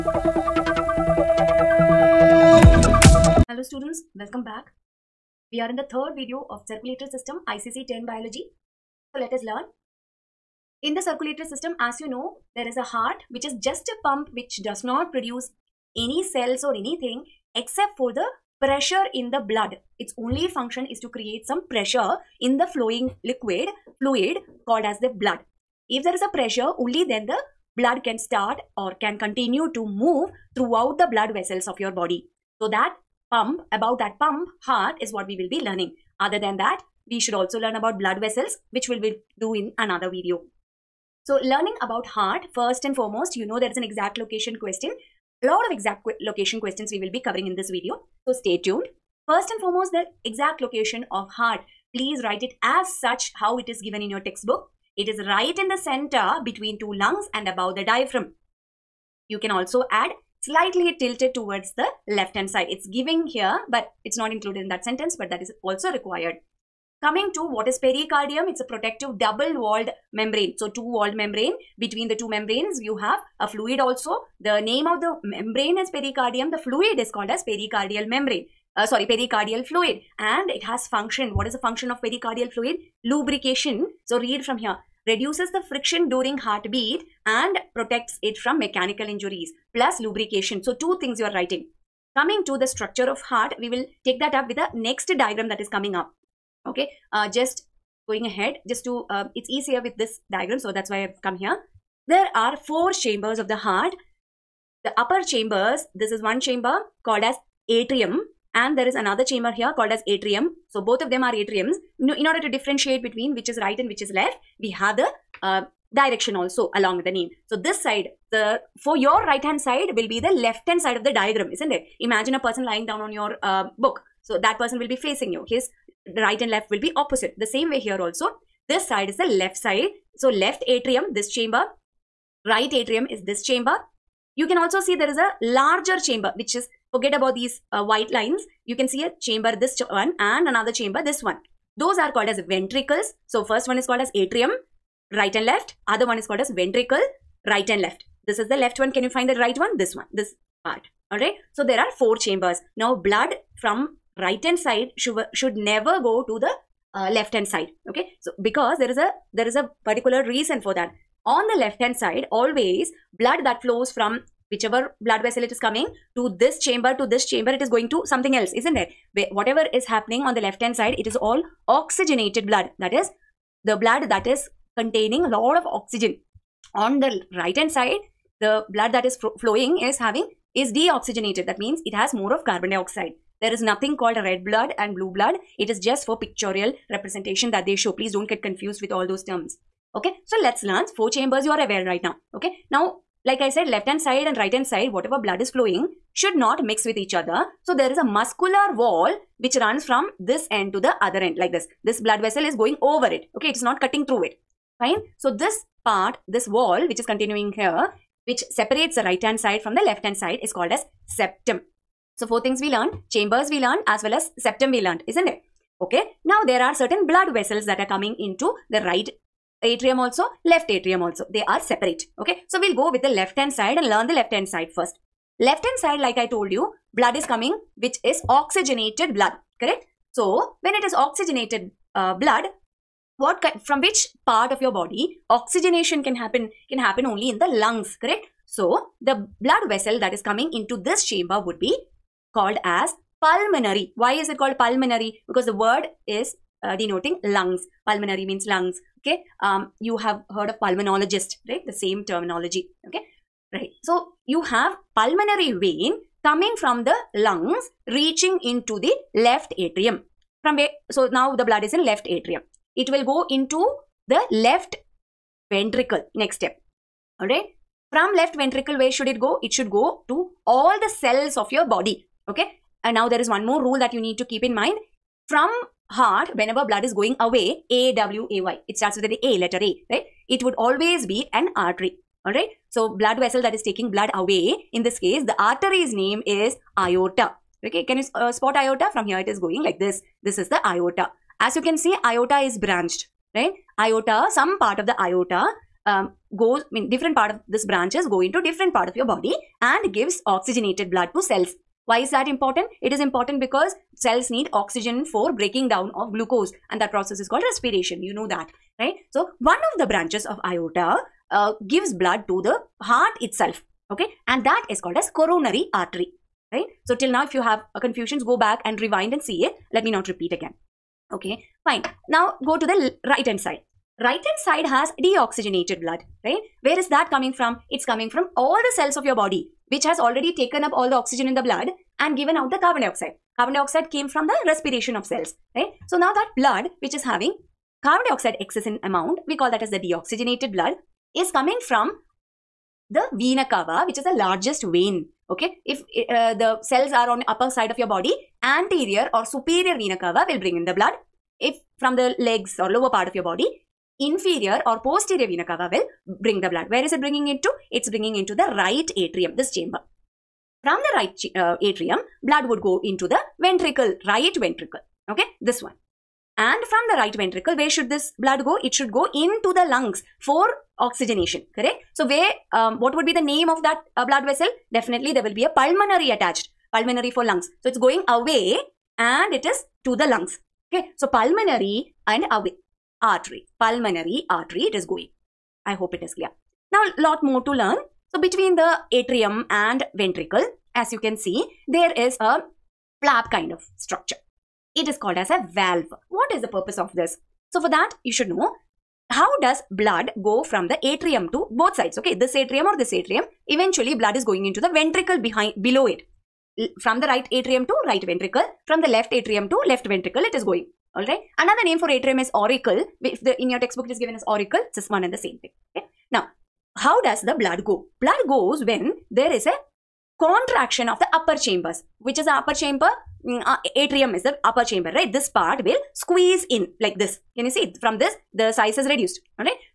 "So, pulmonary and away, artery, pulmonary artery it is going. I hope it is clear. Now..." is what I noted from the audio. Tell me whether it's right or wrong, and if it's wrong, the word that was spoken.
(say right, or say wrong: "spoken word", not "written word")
right.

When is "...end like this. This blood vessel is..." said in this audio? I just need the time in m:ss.
3:21.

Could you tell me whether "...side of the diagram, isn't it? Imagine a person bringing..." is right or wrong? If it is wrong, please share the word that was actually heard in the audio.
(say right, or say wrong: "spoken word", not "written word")
wrong: "lying", not "bringing".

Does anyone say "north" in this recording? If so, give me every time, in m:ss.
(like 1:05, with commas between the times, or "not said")
not said.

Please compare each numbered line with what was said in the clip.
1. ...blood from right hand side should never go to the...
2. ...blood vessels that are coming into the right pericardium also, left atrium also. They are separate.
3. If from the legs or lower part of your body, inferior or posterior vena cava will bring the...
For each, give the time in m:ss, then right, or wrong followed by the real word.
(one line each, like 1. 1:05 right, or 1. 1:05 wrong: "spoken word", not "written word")
1. 2:32 right
2. 3:37 wrong: "atrium", not "pericardium"
3. 5:51 right.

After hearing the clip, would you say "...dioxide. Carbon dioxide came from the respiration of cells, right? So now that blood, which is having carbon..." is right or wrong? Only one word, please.
right.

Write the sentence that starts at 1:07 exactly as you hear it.
Coming to what is pericardium, it's a protective double walled membrane.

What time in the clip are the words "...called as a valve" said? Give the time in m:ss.
6:34.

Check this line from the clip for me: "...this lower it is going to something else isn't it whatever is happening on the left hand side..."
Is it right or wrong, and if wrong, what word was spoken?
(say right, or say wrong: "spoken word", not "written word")
wrong: "chamber", not "lower".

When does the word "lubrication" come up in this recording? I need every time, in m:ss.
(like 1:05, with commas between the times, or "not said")
1:23, 1:29.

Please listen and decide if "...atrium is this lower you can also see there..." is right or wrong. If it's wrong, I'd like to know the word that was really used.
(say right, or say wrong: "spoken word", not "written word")
wrong: "chamber", not "lower".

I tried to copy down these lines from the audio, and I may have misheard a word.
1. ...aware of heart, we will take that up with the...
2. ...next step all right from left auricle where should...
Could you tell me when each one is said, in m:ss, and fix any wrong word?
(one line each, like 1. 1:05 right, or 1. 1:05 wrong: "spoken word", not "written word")
1. 1:32 wrong: "structure", not "aware"
2. 4:26 wrong: "ventricle", not "auricle".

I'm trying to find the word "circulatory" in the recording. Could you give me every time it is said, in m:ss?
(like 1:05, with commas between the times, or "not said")
0:06, 0:11.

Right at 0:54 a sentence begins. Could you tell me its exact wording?
It is right in the center between two lungs and above the diaphragm.